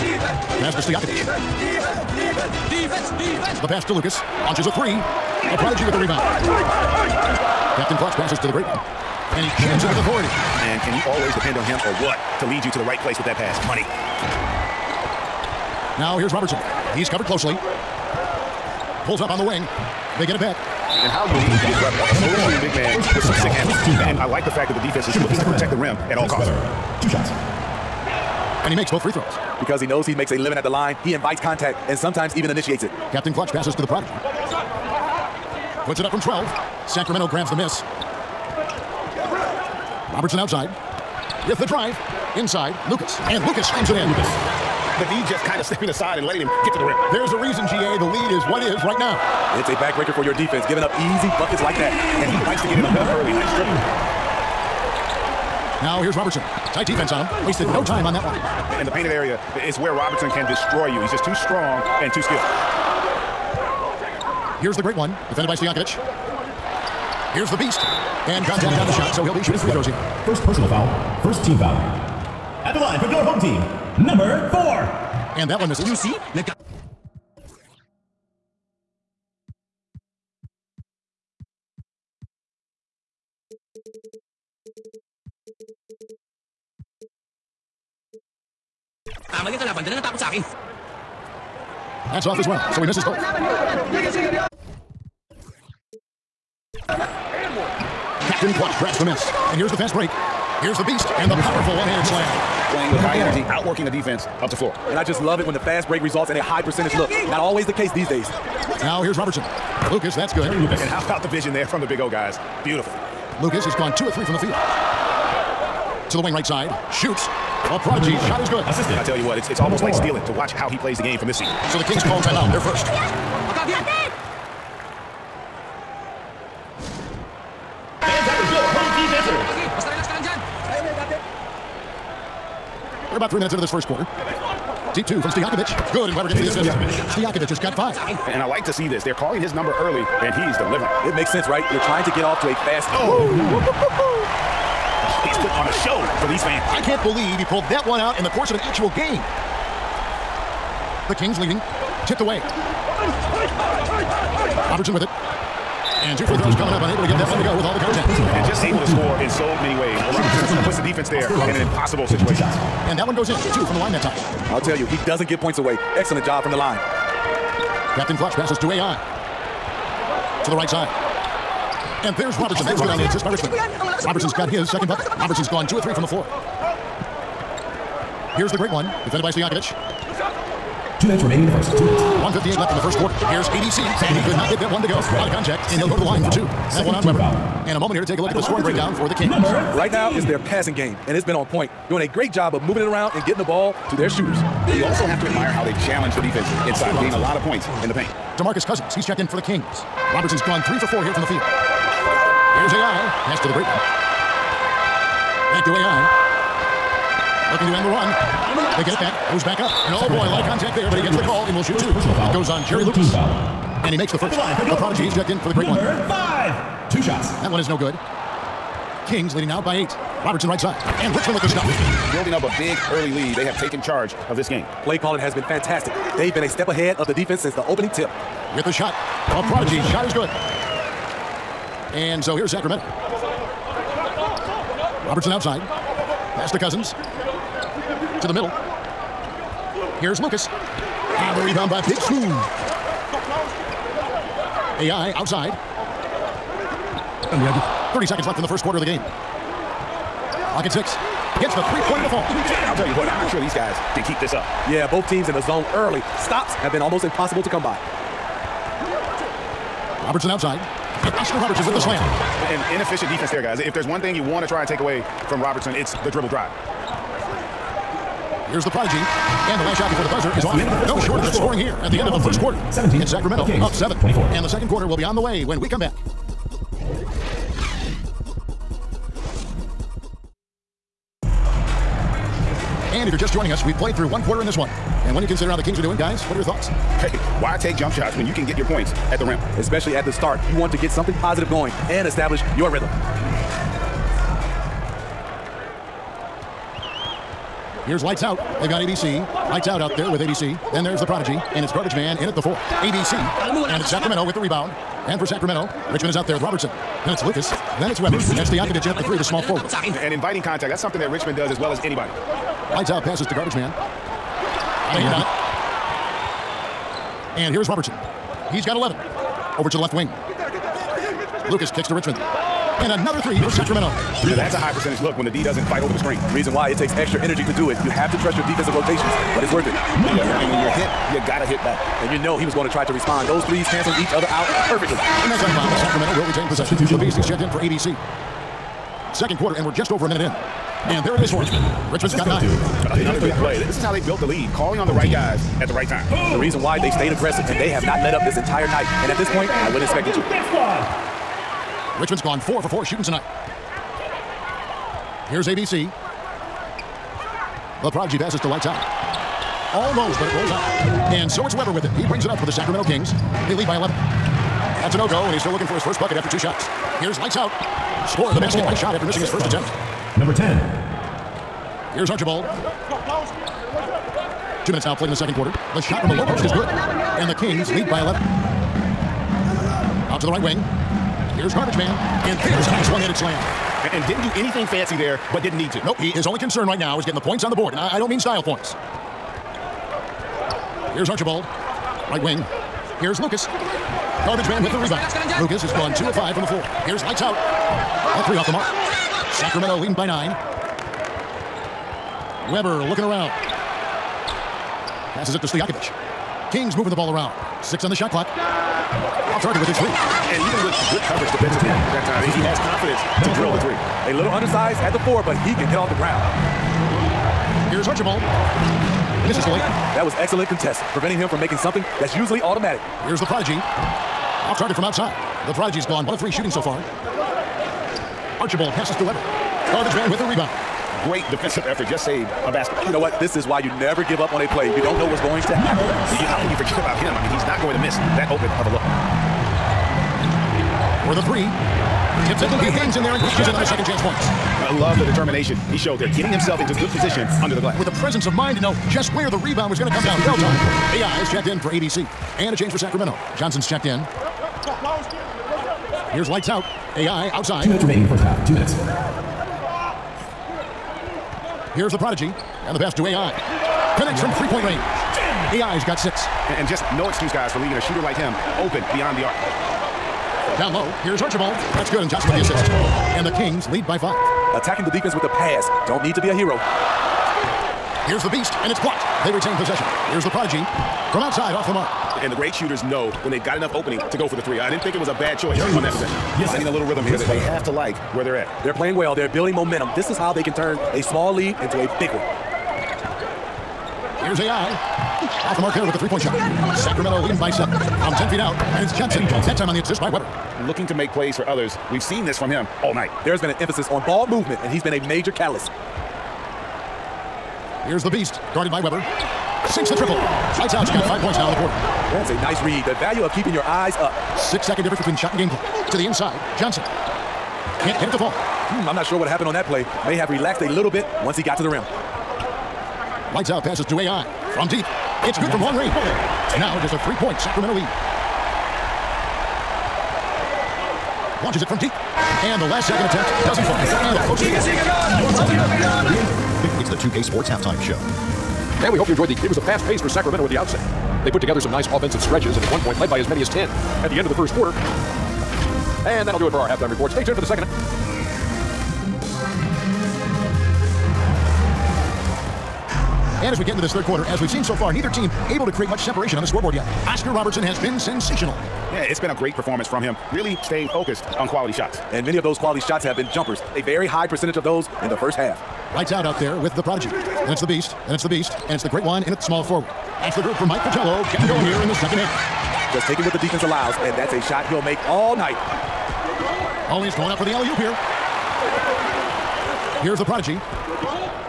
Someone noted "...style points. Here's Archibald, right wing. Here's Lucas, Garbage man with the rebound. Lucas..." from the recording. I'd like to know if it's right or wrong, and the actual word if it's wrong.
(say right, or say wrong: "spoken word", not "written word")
right.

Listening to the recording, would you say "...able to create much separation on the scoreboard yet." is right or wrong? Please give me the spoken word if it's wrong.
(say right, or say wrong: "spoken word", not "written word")
right.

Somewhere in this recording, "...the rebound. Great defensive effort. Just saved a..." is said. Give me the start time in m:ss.
7:10.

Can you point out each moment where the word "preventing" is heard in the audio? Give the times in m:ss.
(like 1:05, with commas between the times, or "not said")
7:00.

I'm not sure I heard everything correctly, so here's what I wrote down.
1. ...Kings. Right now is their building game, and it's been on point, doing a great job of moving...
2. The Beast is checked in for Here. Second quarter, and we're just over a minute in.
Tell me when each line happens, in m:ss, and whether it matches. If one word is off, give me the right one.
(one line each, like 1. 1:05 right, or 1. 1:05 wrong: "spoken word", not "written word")
1. 3:09 wrong: "passing", not "building"
2. 5:36 wrong: "ABC", not "Here".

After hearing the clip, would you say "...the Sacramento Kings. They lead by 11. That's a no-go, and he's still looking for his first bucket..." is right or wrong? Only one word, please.
right.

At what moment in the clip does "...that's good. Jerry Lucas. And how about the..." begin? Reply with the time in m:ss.
1:50.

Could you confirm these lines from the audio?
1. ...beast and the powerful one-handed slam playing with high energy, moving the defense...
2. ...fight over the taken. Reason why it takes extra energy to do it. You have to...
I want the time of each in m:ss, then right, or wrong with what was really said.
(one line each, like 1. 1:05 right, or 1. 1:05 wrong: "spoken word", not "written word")
1. 1:40 wrong: "outworking", not "moving"
2. 5:25 wrong: "screen", not "taken".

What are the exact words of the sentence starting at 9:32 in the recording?
Just taking what the defense allows, and that's a shot he'll make all night.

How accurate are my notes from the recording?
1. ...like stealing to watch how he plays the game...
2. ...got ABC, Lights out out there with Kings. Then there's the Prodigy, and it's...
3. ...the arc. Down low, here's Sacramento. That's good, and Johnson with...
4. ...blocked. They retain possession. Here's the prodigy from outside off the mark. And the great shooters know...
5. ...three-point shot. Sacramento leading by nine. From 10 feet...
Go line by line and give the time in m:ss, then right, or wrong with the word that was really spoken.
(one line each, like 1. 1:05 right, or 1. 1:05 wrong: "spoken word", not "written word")
1. 1:59 right
2. 4:58 wrong: "ABC", not "Kings"
3. 7:49 wrong: "Archibald", not "Sacramento"
4. 7:58 right
5. 8:15 wrong: "seven", not "nine".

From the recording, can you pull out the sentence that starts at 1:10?
First personal foul, first team foul.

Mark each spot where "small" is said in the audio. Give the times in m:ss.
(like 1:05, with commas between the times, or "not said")
5:09, 8:11, 9:29.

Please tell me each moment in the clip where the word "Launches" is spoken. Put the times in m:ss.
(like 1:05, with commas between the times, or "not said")
0:04, 8:51.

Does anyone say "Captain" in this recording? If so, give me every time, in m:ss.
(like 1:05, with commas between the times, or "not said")
0:07, 0:33, 1:38, 2:47.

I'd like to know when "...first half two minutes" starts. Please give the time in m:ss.
7:38.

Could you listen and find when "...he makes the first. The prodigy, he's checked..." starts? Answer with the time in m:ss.
3:33.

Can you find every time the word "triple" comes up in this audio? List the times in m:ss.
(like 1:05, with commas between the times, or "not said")
0:53, 8:29.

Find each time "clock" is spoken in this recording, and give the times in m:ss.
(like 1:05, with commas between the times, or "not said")
4:10, 6:48, 8:35.